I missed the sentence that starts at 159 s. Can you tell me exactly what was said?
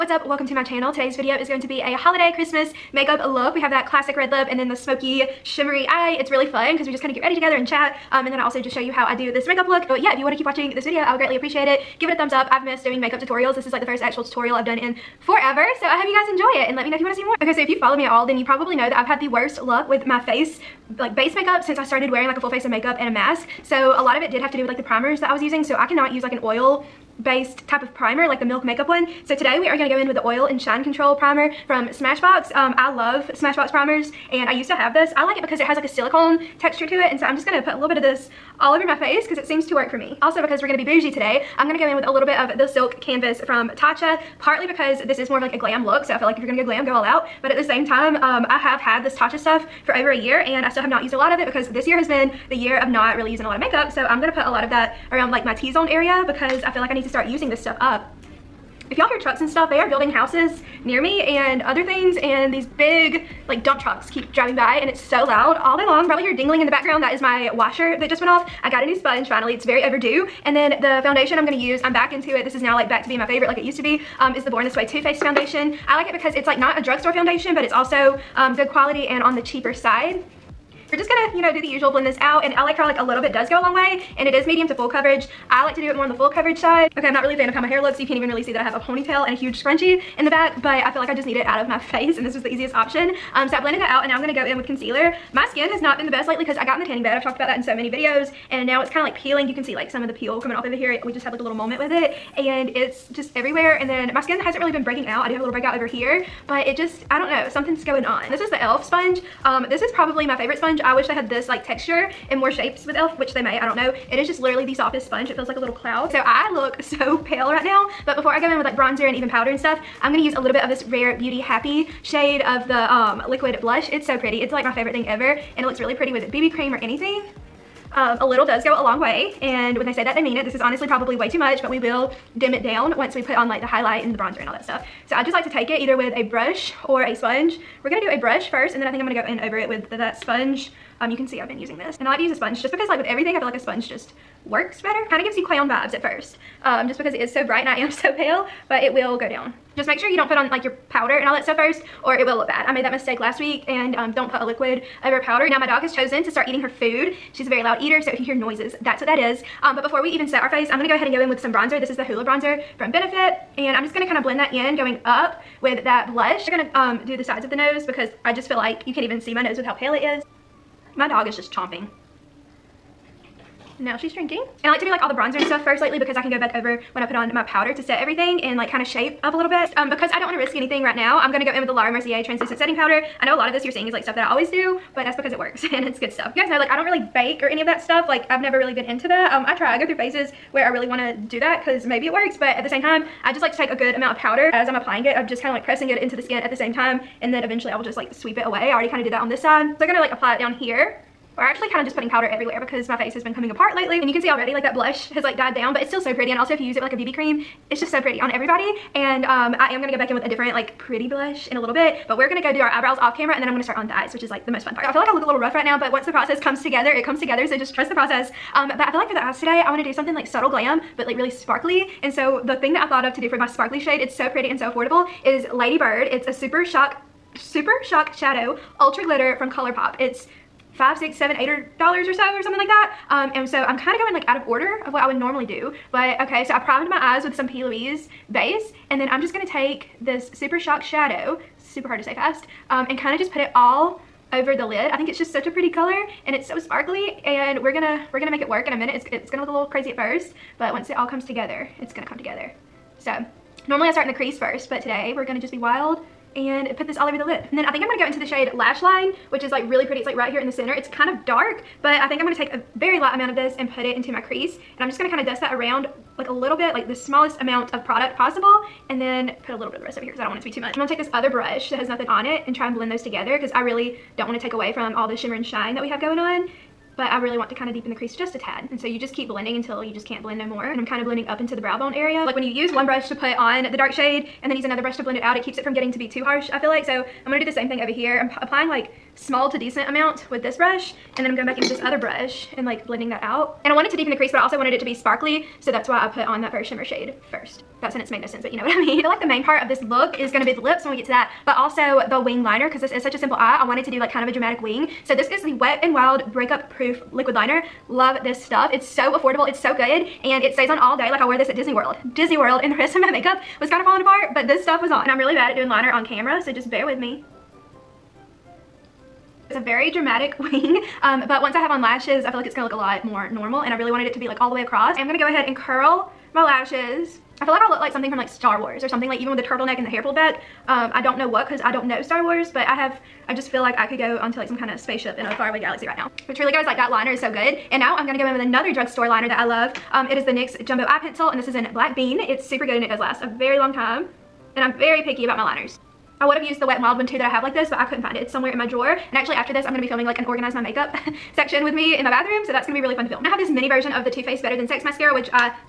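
Um, but before we even set our face, I'm gonna go ahead and go in with some bronzer.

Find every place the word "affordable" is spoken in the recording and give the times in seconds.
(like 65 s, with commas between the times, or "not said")
224 s, 309 s.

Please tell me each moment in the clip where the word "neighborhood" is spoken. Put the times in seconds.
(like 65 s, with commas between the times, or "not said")
not said.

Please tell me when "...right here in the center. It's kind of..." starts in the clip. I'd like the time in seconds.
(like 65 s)
260 s.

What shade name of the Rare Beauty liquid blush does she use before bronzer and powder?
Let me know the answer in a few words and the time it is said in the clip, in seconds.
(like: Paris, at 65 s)
Happy, at 121 s.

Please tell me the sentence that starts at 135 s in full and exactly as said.
So I just like to take it either with a brush or a sponge.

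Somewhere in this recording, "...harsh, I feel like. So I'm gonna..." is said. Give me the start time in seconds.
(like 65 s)
286 s.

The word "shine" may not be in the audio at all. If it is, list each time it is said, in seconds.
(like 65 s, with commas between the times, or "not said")
30 s, 275 s.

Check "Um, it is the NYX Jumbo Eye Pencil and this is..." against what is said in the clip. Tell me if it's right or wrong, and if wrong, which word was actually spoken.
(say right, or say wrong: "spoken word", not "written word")
right.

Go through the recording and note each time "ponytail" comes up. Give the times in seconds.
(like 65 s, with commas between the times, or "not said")
88 s.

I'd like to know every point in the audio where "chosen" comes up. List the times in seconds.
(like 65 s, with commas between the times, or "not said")
155 s.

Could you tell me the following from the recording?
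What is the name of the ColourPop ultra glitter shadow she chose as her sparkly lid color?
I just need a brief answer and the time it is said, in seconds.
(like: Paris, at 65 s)
Lady Bird, at 225 s.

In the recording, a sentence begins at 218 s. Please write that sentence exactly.
Um, but I feel like for the eyes today, I wanna do something like subtle glam, but like really sparkly.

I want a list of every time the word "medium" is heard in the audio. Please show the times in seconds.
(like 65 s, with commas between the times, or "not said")
84 s.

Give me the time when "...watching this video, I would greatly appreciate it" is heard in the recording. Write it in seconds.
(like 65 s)
10 s.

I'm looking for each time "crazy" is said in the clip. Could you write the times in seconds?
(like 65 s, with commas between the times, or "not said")
249 s.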